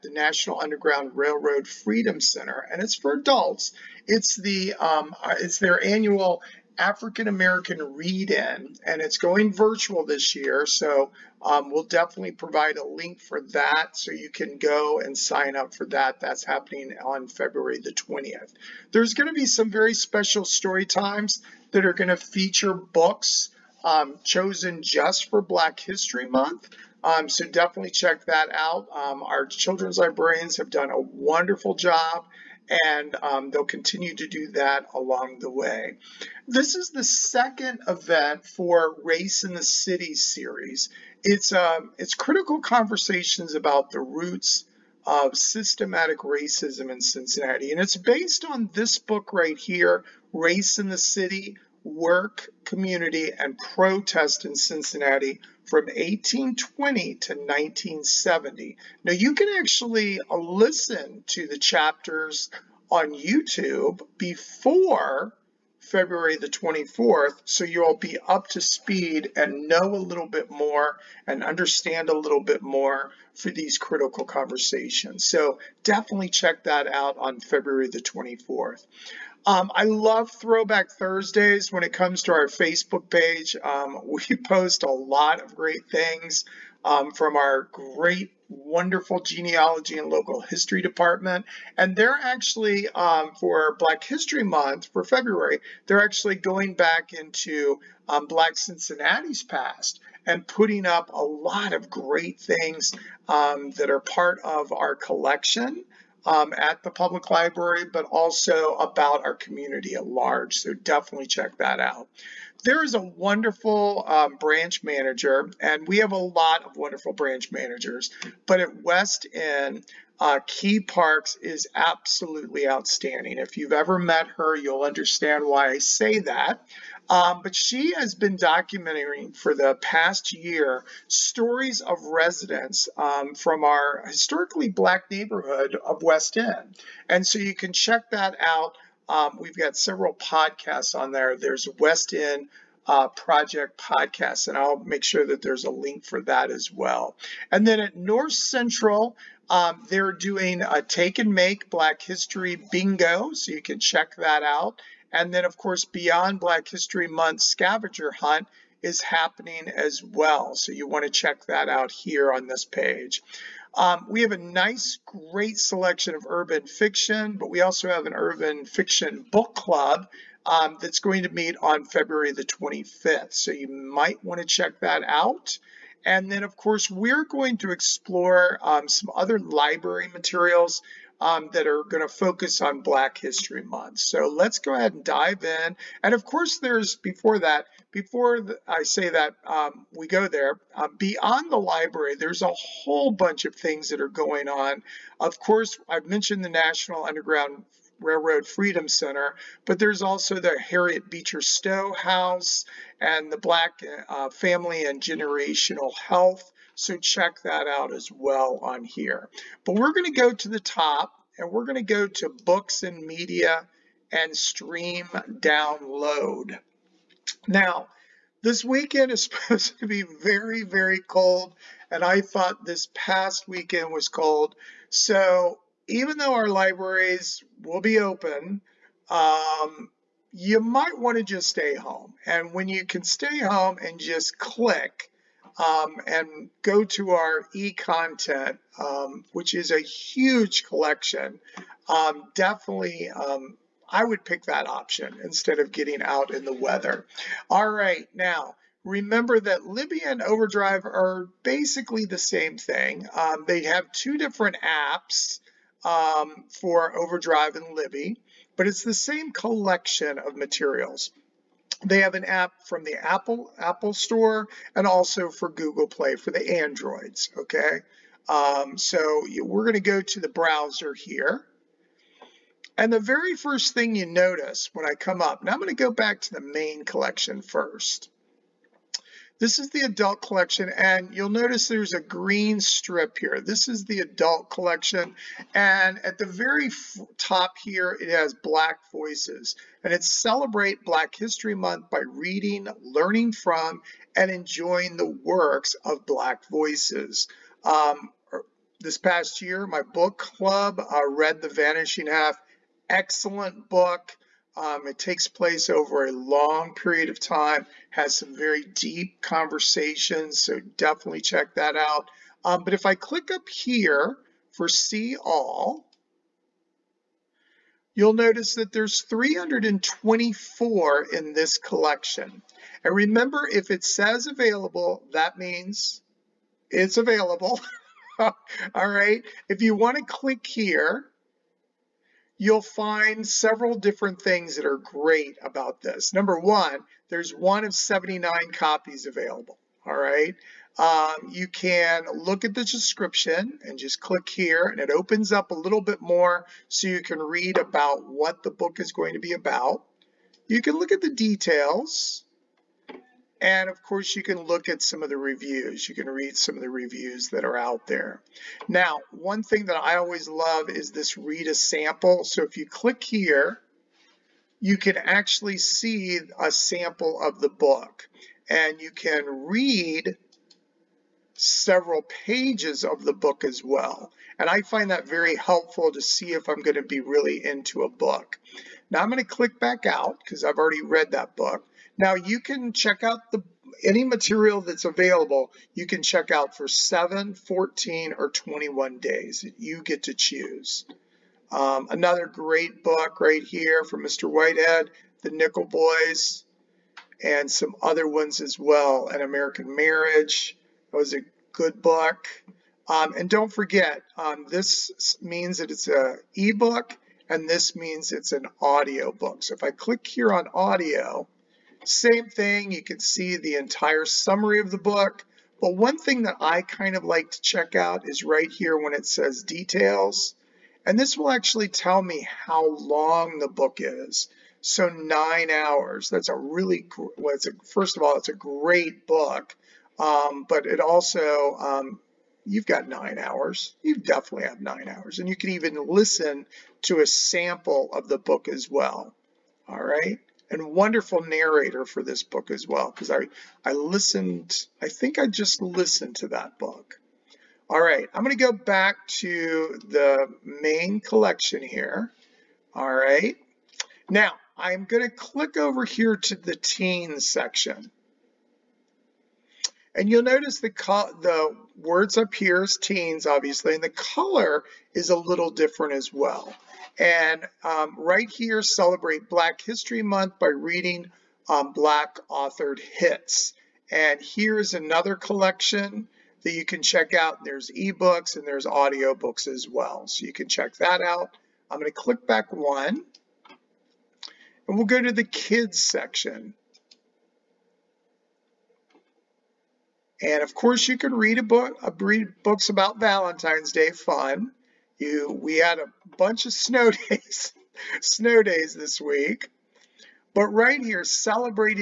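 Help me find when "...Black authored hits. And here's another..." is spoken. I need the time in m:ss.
7:51.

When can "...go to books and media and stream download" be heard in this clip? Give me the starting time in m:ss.
3:31.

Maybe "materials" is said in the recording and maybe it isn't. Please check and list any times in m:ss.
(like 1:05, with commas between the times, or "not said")
3:00, 4:20, 6:24.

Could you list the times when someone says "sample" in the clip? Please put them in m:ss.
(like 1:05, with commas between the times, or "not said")
6:01, 6:06, 7:17.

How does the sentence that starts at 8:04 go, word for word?
And we'll go to the kids section.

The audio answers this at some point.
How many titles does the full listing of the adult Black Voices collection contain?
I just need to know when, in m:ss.
5:18.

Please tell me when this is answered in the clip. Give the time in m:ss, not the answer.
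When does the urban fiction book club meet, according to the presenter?
2:51.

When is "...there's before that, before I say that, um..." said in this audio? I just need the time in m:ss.
3:06.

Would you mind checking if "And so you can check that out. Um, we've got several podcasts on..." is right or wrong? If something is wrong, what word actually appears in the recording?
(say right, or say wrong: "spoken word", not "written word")
right.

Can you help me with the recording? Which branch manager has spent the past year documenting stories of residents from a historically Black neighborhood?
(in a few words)
Key Parks.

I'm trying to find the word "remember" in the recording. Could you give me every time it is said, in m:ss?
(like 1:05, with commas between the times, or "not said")
4:08, 5:22.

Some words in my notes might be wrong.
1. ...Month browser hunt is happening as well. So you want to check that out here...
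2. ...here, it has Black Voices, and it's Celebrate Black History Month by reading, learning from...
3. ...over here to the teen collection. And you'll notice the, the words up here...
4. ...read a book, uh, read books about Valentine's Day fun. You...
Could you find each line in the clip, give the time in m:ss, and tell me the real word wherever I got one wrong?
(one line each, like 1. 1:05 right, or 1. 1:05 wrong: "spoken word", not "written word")
1. 2:37 wrong: "scavenger", not "browser"
2. 4:47 right
3. 7:35 wrong: "section", not "collection"
4. 8:11 right.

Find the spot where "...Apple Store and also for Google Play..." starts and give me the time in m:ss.
4:23.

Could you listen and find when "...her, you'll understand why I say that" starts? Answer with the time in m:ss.
2:04.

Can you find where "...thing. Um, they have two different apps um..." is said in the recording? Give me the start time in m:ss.
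4:12.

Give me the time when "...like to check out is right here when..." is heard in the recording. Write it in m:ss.
6:57.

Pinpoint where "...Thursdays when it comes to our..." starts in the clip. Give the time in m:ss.
1:20.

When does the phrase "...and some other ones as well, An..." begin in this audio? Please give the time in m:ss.
6:37.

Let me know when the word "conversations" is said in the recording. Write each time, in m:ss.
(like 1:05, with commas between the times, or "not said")
0:42, 1:14, 5:09.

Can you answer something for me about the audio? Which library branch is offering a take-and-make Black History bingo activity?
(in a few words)
North Central.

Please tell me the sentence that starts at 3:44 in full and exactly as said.
So even though our libraries will be open, um, you might want to just stay home.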